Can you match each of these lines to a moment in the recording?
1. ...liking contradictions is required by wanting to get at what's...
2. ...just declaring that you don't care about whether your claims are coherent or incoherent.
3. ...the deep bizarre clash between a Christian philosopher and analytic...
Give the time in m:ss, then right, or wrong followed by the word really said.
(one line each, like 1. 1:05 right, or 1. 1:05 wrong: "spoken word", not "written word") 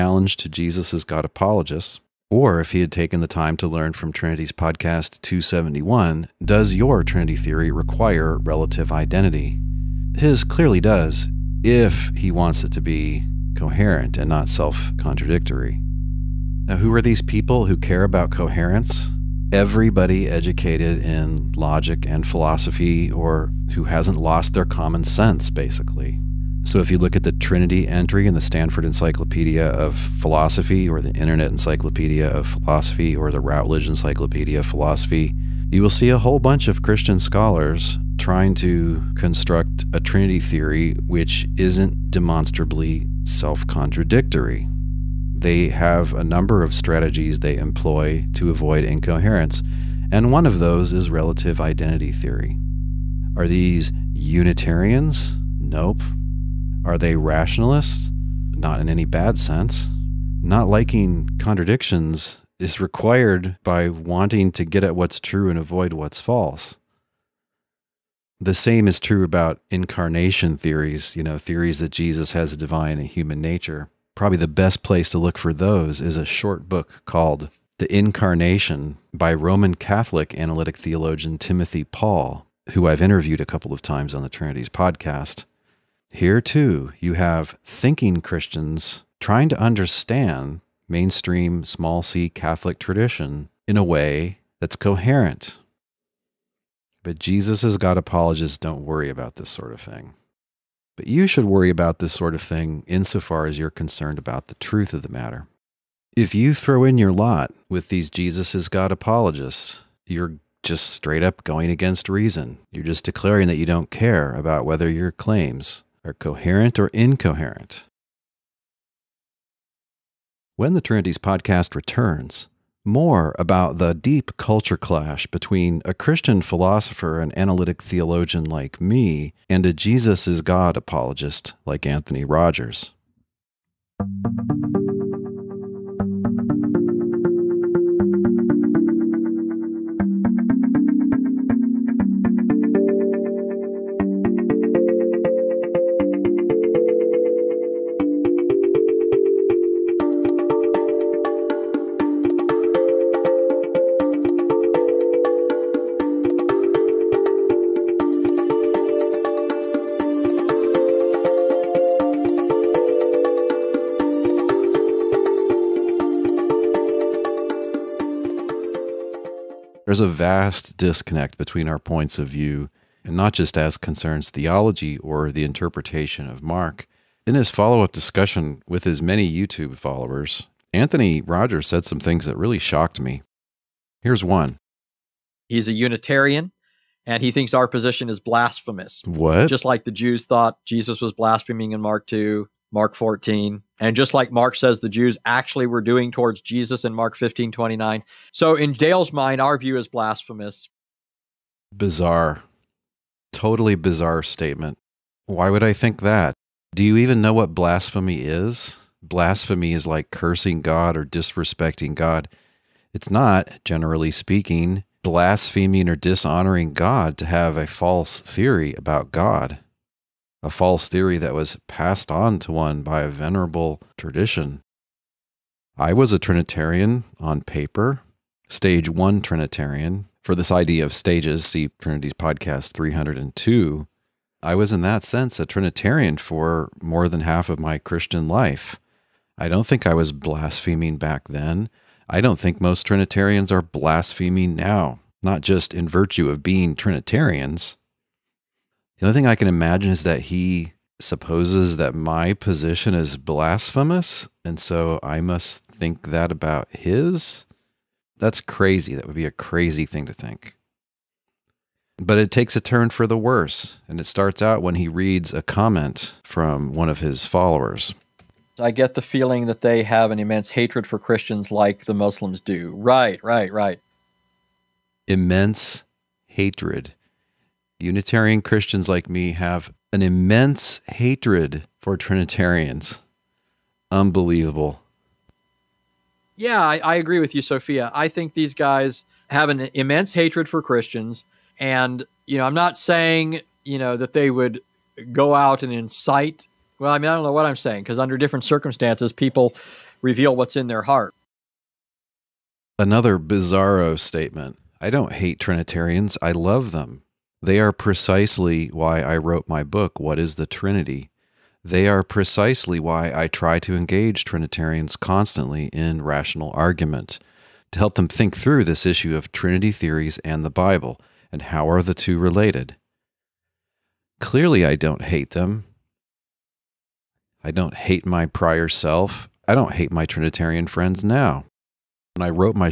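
1. 1:00 right
2. 1:52 right
3. 2:03 wrong: "culture", not "bizarre".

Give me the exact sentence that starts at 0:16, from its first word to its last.
Now, who are these people who care about coherence?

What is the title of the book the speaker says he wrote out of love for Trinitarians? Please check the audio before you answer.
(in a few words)
What is the Trinity?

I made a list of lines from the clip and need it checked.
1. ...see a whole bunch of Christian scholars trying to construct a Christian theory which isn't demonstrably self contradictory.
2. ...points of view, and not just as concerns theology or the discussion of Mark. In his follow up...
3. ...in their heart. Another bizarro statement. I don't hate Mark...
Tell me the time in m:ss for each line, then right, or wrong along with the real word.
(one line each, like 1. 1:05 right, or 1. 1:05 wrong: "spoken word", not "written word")
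1. 0:35 wrong: "Trinity", not "Christian"
2. 2:51 wrong: "interpretation", not "discussion"
3. 5:00 wrong: "Trinitarians", not "Mark".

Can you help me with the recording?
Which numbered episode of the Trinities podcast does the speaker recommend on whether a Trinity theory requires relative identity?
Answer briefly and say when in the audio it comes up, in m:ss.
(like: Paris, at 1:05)
271, at 0:05.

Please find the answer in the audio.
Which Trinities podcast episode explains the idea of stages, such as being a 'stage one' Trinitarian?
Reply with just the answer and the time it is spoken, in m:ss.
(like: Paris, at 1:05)
302, at 3:52.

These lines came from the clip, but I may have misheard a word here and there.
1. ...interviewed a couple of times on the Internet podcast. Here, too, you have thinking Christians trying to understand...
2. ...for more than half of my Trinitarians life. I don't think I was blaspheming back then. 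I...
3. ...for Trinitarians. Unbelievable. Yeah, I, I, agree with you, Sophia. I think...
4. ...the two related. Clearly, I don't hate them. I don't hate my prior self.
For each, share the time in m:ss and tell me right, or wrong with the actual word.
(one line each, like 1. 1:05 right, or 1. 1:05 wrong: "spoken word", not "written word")
1. 1:23 wrong: "Trinities", not "Internet"
2. 3:56 wrong: "Christian", not "Trinitarians"
3. 4:41 right
4. 5:21 right.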